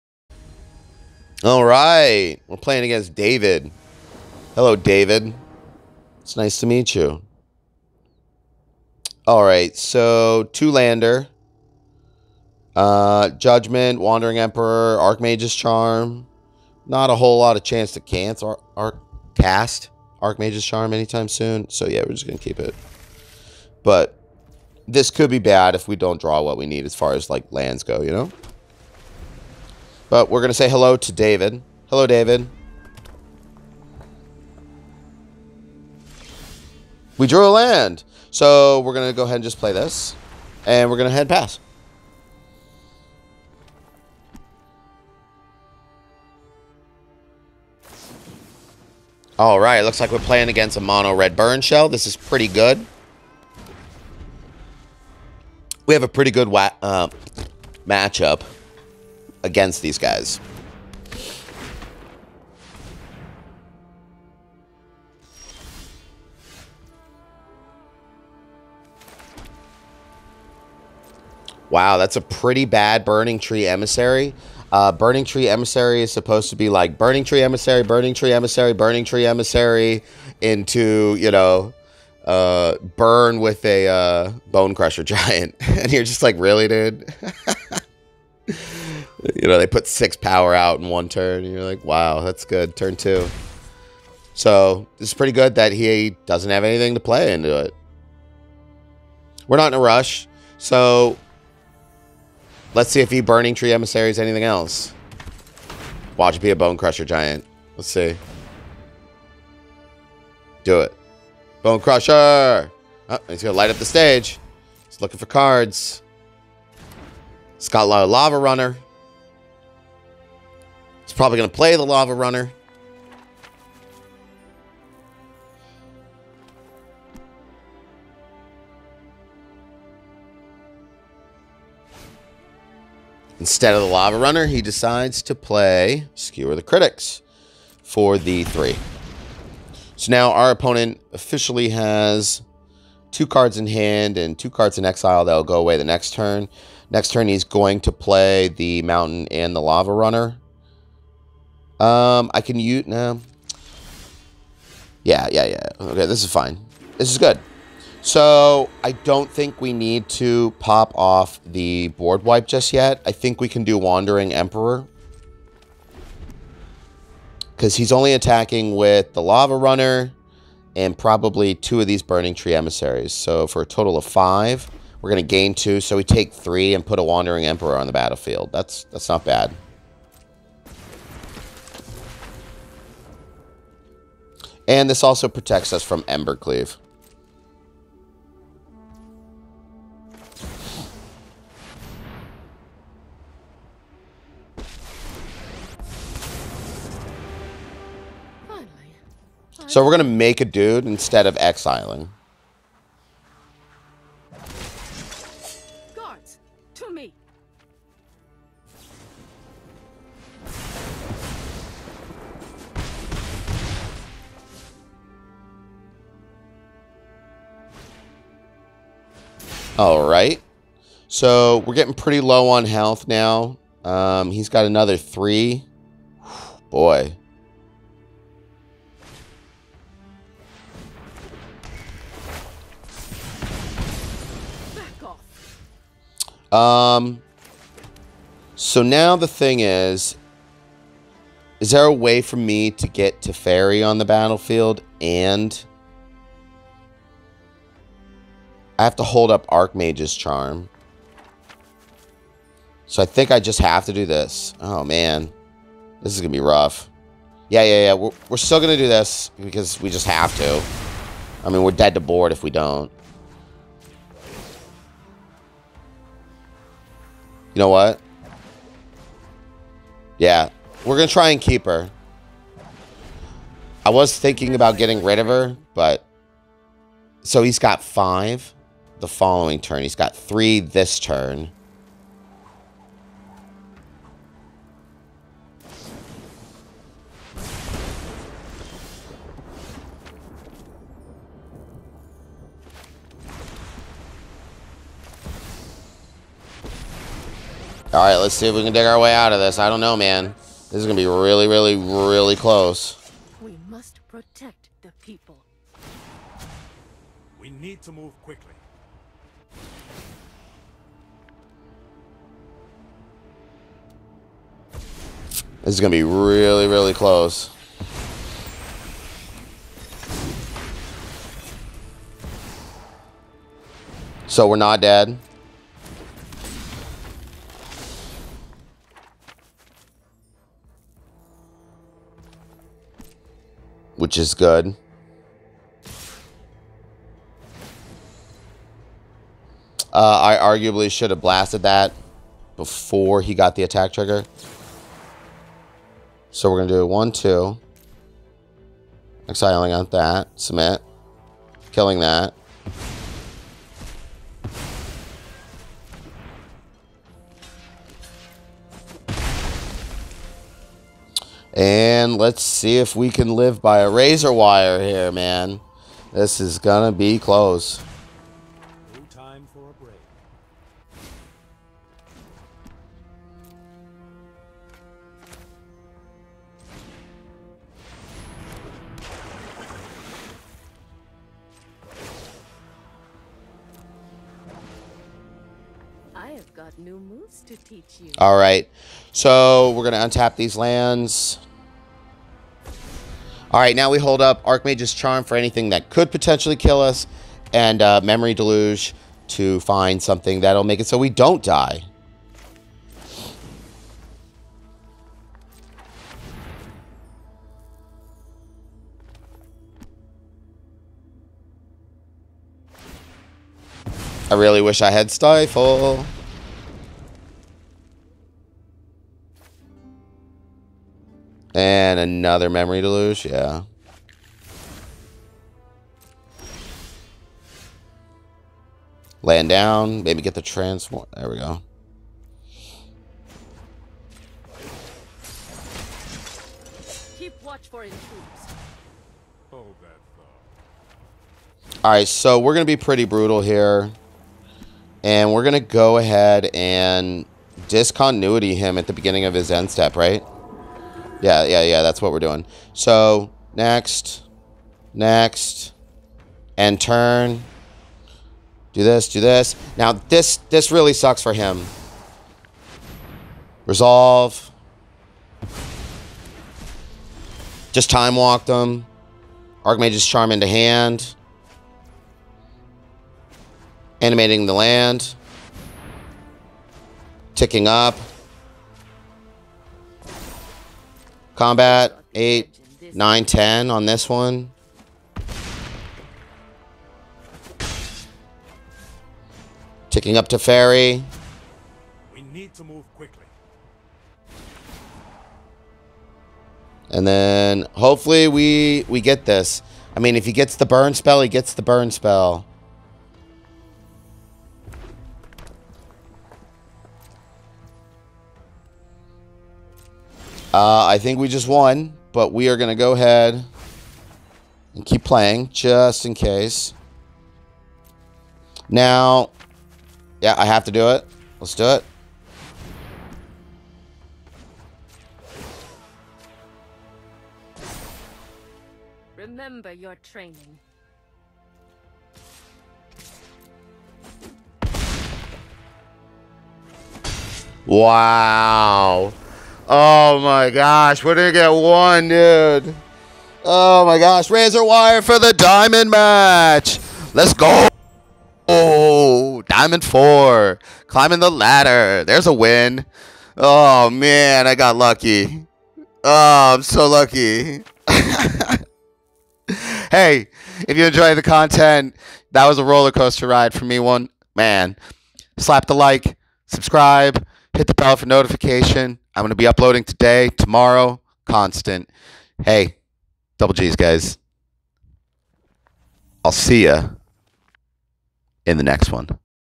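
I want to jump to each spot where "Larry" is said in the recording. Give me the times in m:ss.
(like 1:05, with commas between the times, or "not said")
not said.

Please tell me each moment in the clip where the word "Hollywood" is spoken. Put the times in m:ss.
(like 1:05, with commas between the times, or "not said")
not said.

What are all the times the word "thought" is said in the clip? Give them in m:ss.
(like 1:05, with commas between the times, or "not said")
7:21.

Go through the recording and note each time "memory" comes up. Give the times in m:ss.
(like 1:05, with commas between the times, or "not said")
6:38, 7:02.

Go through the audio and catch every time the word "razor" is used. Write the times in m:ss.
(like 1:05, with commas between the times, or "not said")
6:03, 9:04.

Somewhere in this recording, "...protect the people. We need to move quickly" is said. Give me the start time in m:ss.
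5:04.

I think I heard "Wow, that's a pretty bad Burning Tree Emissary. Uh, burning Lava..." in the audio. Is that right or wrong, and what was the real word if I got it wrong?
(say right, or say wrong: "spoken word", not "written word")
wrong: "Tree", not "Lava".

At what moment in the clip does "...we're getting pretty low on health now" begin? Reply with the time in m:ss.
3:41.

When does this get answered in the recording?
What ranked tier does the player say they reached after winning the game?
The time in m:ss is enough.
9:09.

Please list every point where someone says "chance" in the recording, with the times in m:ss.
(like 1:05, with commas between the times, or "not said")
0:17.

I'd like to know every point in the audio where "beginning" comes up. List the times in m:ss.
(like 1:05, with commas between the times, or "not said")
7:28.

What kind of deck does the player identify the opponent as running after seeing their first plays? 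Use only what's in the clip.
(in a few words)
Mono red burn.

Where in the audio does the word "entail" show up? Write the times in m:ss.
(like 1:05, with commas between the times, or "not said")
not said.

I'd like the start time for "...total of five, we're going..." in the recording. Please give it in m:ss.
2:53.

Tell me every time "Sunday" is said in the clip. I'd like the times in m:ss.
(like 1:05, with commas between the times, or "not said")
not said.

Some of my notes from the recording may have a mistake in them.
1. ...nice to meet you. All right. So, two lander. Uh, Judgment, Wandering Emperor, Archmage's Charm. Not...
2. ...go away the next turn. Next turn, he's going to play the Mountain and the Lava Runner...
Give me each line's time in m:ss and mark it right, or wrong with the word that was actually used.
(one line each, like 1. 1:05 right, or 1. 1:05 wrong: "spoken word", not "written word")
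1. 0:06 right
2. 2:25 right.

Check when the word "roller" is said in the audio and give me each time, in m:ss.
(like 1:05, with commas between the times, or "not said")
9:22.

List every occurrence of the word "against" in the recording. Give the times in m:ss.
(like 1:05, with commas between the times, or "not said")
0:02, 0:50, 0:59.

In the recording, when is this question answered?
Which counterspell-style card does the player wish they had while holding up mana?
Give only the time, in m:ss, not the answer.
6:55.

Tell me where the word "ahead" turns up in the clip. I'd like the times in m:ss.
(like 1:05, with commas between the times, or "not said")
0:39, 7:25, 8:32.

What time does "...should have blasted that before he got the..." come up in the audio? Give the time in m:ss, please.
5:40.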